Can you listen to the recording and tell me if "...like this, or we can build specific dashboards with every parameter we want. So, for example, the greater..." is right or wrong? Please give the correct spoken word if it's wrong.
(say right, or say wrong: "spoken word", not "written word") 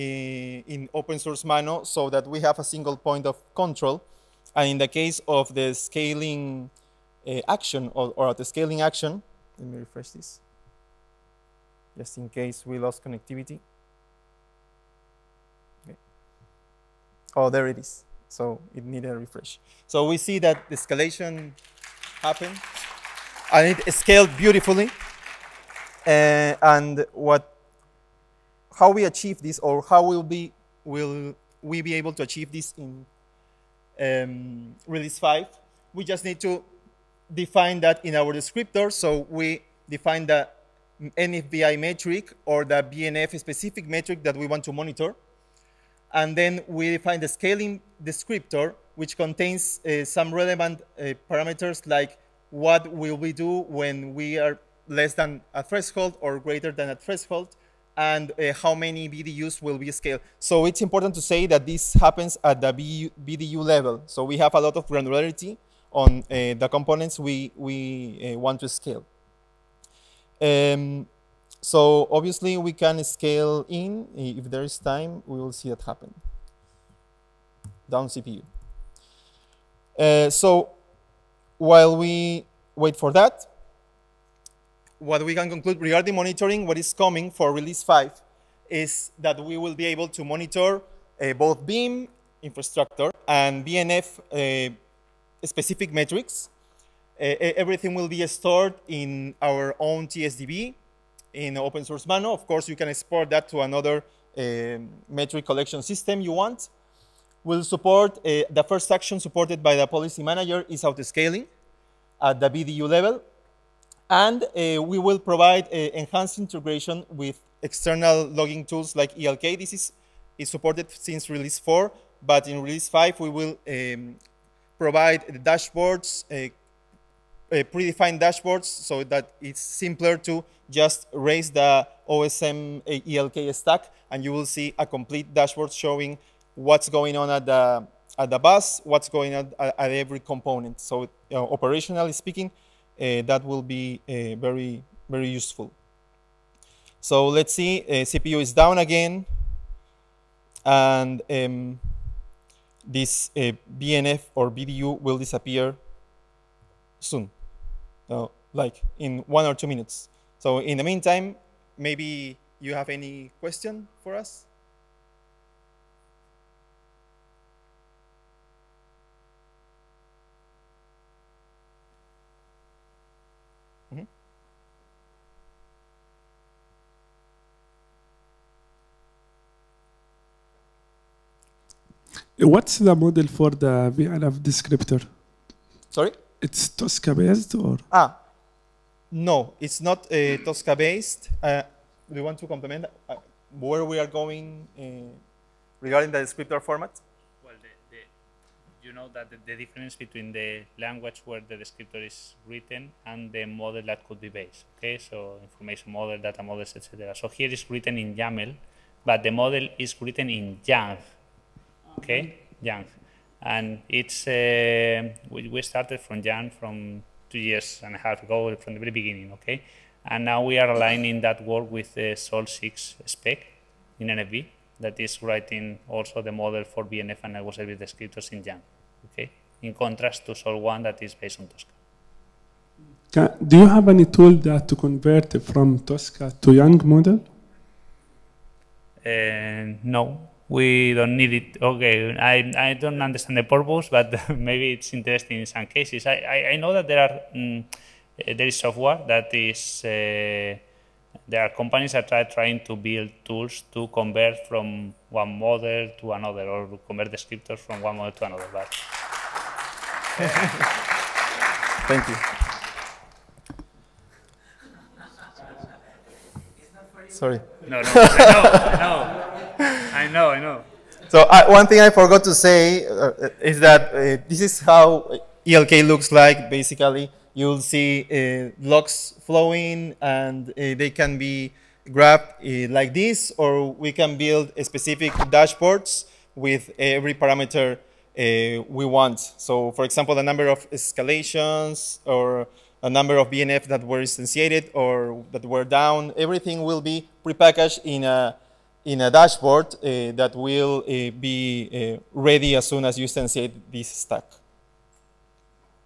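wrong: "number", not "greater".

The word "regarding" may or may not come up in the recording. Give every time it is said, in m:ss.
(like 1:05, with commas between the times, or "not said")
1:25, 3:15.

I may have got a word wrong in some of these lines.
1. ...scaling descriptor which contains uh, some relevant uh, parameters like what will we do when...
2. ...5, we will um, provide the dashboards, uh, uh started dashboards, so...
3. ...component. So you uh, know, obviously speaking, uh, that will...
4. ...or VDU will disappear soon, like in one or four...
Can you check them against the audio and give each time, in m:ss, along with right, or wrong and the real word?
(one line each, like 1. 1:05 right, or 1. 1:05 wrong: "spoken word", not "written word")
1. 0:47 right
2. 2:02 wrong: "predefined", not "started"
3. 2:20 wrong: "operationally", not "obviously"
4. 2:34 wrong: "two", not "four".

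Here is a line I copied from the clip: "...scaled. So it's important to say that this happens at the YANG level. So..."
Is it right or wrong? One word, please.
wrong.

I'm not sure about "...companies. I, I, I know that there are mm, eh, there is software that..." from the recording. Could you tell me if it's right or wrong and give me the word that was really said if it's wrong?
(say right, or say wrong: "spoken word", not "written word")
wrong: "cases", not "companies".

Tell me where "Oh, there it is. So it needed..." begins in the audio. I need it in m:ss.
0:17.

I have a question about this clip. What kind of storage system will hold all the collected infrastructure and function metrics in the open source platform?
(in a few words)
TSDB.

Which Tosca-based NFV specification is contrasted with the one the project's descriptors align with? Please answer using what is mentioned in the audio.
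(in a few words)
Sol 1.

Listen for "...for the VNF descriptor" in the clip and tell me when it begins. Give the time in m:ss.
3:03.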